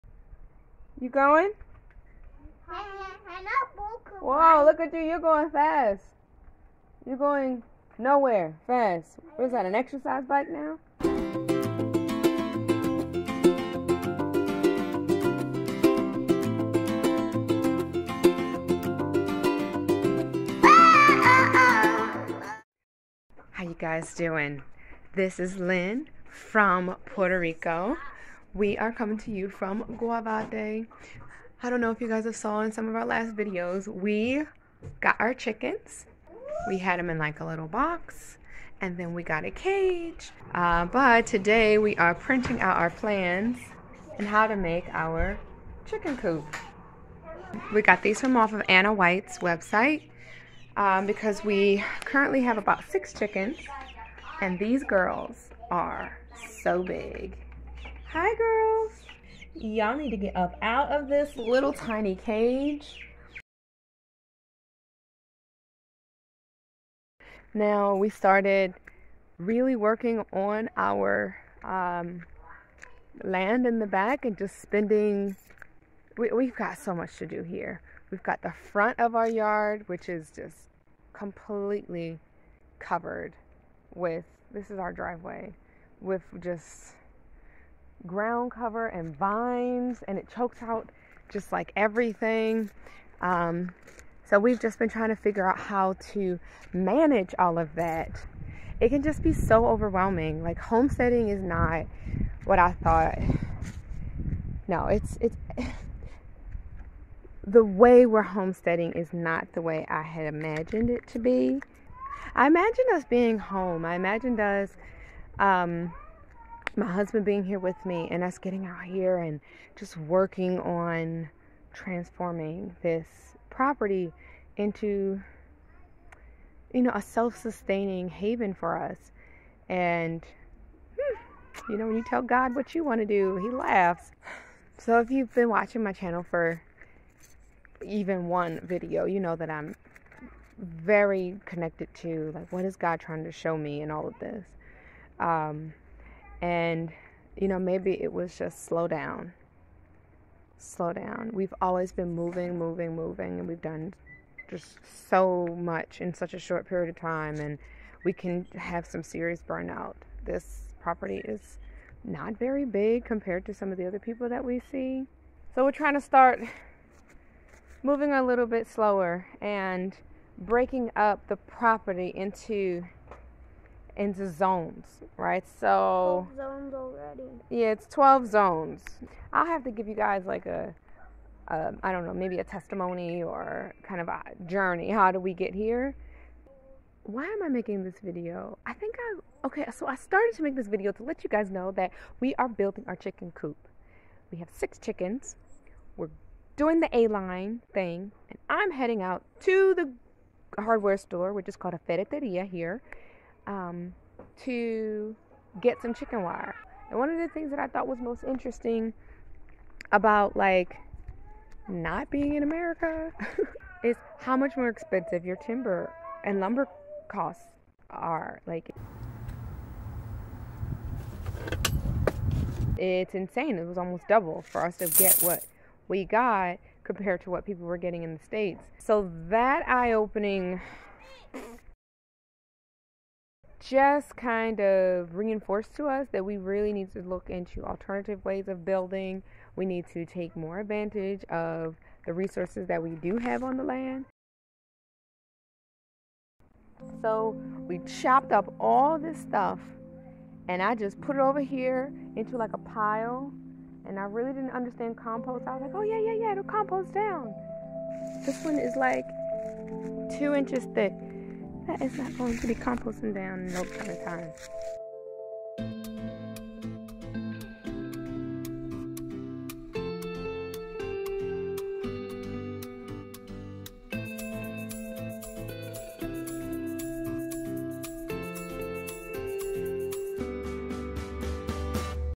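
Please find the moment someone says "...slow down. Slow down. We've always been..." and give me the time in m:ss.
2:28.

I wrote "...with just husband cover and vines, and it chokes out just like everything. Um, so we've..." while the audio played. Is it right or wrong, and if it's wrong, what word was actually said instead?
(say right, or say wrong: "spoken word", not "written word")
wrong: "ground", not "husband".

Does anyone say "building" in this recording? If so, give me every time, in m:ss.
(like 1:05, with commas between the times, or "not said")
3:12, 3:58.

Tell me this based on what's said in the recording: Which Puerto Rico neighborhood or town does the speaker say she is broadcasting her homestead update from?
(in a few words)
Guavate.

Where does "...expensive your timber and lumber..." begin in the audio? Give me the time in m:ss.
3:34.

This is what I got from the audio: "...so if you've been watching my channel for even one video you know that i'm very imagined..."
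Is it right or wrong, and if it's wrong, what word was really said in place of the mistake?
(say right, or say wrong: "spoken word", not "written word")
wrong: "connected", not "imagined".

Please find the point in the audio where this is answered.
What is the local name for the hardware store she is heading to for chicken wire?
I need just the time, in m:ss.
3:21.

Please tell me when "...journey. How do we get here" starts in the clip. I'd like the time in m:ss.
3:04.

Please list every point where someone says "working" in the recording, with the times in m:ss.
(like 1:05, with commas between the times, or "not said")
1:09, 1:59.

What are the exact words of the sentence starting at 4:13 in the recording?
And I really didn't understand compost.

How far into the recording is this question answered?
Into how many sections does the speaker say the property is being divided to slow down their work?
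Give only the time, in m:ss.
2:57.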